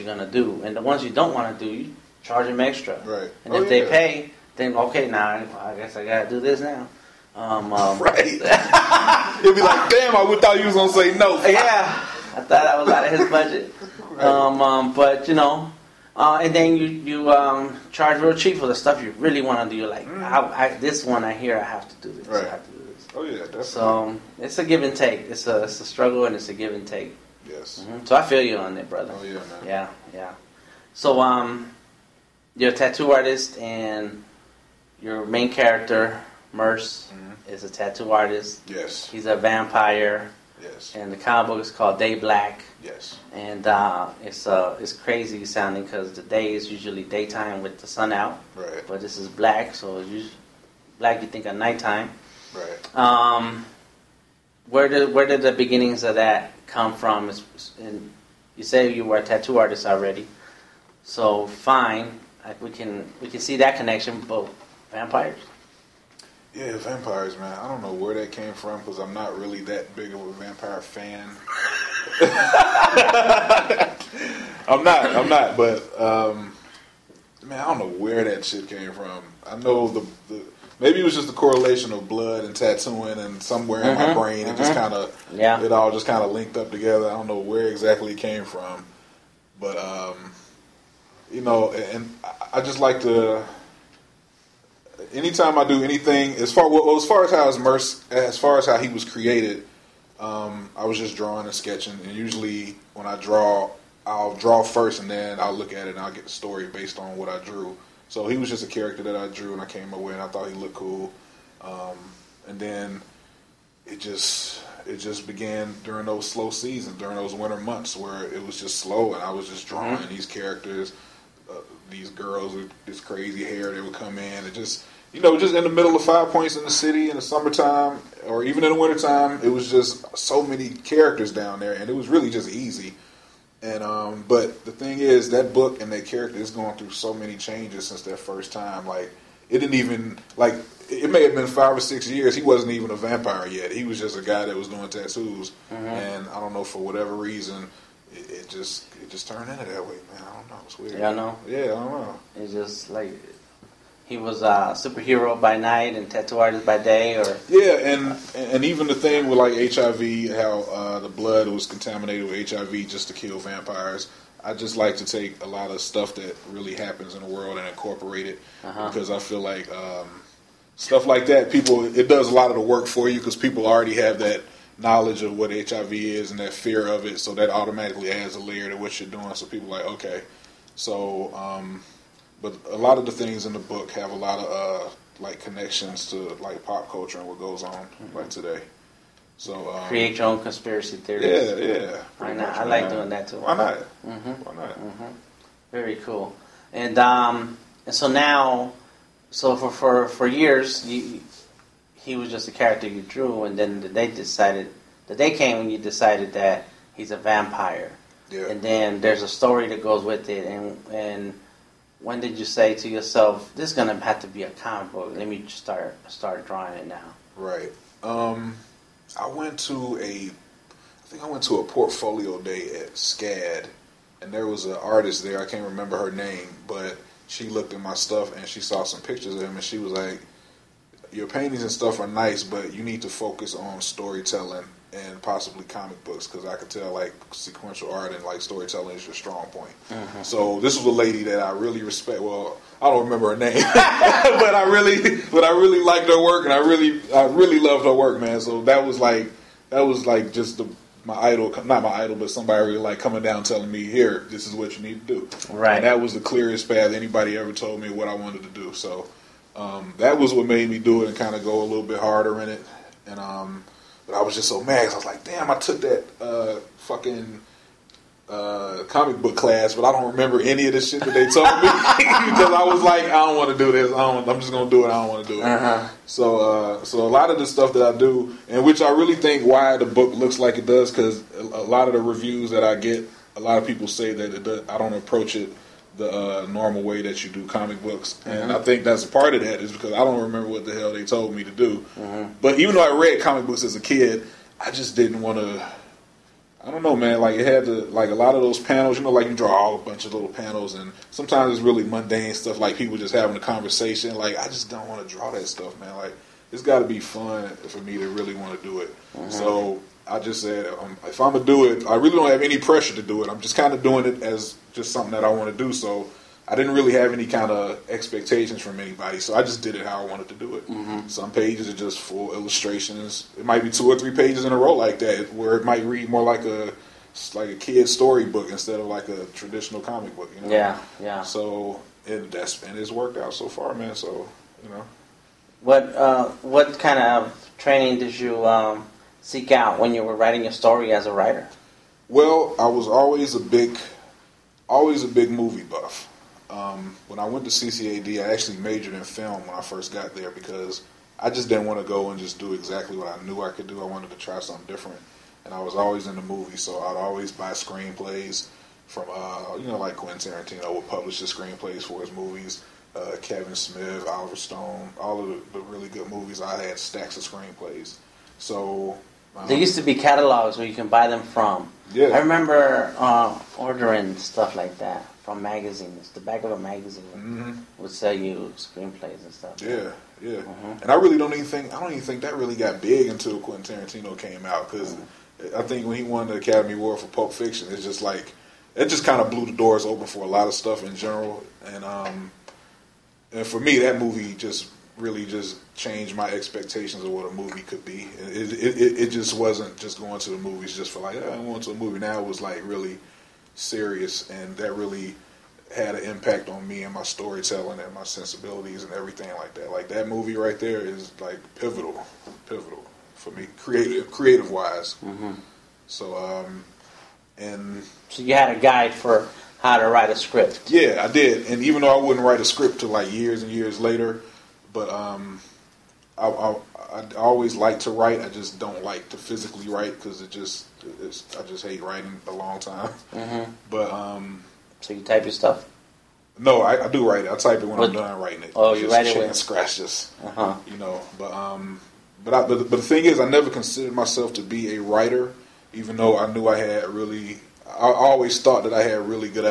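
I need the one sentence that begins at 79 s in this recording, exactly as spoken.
I know the, the maybe it was just the correlation of blood and tattooing, and somewhere mm-hmm, in my mm-hmm.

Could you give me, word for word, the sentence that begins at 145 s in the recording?
and I don't know for whatever reason, it, it just it just turned into that way, man.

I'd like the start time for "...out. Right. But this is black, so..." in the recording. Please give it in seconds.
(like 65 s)
48 s.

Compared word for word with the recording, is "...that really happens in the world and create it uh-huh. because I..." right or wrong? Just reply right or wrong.
wrong.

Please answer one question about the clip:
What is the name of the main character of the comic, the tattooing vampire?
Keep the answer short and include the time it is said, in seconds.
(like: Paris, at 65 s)
Mercer, at 36 s.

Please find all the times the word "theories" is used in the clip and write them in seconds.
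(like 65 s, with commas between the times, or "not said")
190 s.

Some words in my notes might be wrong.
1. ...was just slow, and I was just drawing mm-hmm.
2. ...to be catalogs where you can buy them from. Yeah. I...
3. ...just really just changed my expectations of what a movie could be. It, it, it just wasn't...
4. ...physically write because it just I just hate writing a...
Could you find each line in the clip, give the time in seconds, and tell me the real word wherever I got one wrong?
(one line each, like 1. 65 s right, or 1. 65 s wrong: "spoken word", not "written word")
1. 118 s right
2. 369 s right
3. 394 s right
4. 429 s right.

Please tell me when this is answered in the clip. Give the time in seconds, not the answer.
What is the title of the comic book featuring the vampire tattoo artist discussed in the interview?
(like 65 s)
41 s.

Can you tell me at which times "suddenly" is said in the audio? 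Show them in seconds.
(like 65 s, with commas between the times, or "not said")
not said.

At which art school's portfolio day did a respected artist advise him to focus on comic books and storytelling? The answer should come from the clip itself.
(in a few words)
SCAD.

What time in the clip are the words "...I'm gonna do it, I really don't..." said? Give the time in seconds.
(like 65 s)
311 s.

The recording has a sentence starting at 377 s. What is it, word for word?
would sell you screenplays and stuff.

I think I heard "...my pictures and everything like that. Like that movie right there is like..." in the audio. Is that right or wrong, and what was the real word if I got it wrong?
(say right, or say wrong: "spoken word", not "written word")
wrong: "sensibilities", not "pictures".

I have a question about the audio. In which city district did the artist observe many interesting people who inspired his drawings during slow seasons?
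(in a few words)
Five Points.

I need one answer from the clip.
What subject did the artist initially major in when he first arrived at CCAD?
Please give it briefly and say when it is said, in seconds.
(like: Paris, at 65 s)
Film, at 349 s.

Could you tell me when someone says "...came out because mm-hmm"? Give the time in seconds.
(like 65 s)
384 s.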